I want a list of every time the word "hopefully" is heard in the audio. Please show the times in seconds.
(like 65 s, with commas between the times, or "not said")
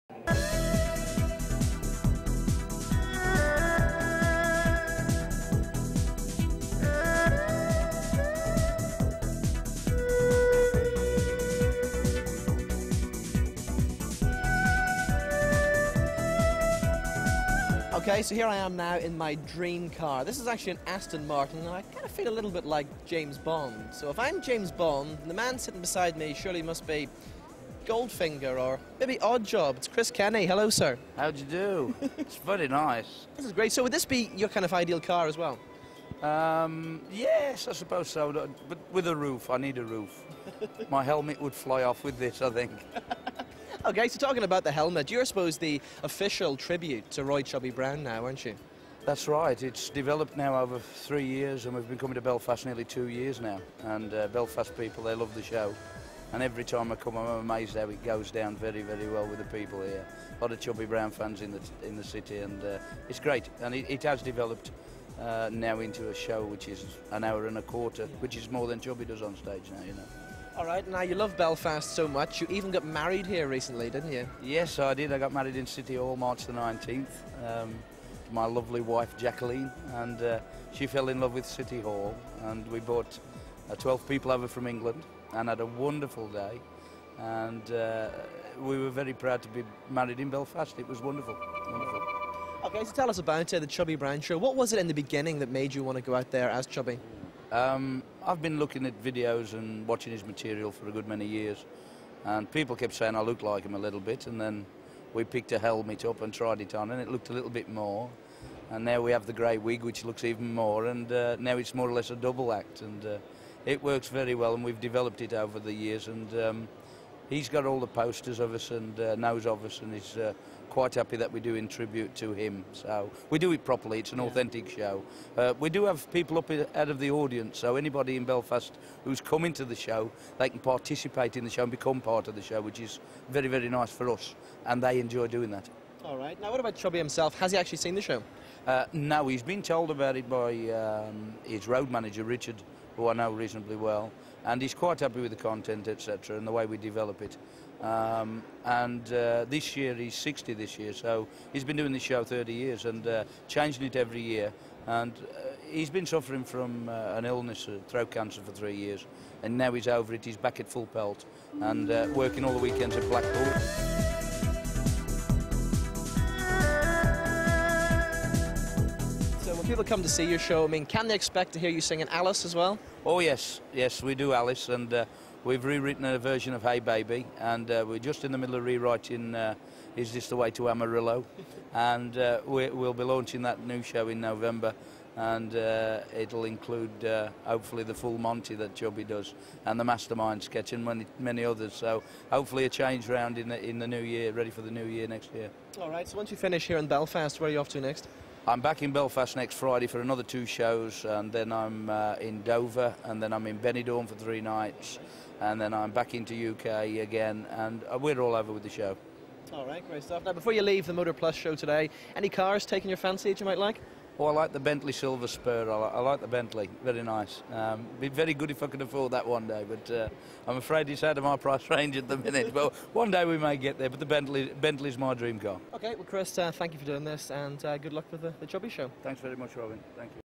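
187 s, 192 s.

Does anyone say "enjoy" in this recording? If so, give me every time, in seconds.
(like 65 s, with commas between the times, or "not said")
134 s.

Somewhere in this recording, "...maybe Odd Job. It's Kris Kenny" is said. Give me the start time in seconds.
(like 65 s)
28 s.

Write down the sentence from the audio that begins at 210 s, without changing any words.
Now, before you leave the Motor Plus show today, any cars taking your fancy that you might like?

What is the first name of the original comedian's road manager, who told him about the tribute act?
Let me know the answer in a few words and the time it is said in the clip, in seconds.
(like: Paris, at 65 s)
Richard, at 142 s.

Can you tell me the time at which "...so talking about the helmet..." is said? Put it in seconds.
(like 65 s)
44 s.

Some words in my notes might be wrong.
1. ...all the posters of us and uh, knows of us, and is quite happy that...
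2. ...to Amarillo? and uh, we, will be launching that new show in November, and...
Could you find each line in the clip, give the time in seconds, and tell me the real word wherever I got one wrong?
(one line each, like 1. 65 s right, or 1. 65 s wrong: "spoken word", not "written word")
1. 117 s right
2. 180 s right.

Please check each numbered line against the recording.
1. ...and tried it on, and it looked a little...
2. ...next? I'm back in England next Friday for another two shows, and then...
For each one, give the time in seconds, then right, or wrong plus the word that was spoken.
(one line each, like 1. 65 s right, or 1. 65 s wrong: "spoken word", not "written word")
1. 106 s right
2. 197 s wrong: "Belfast", not "England".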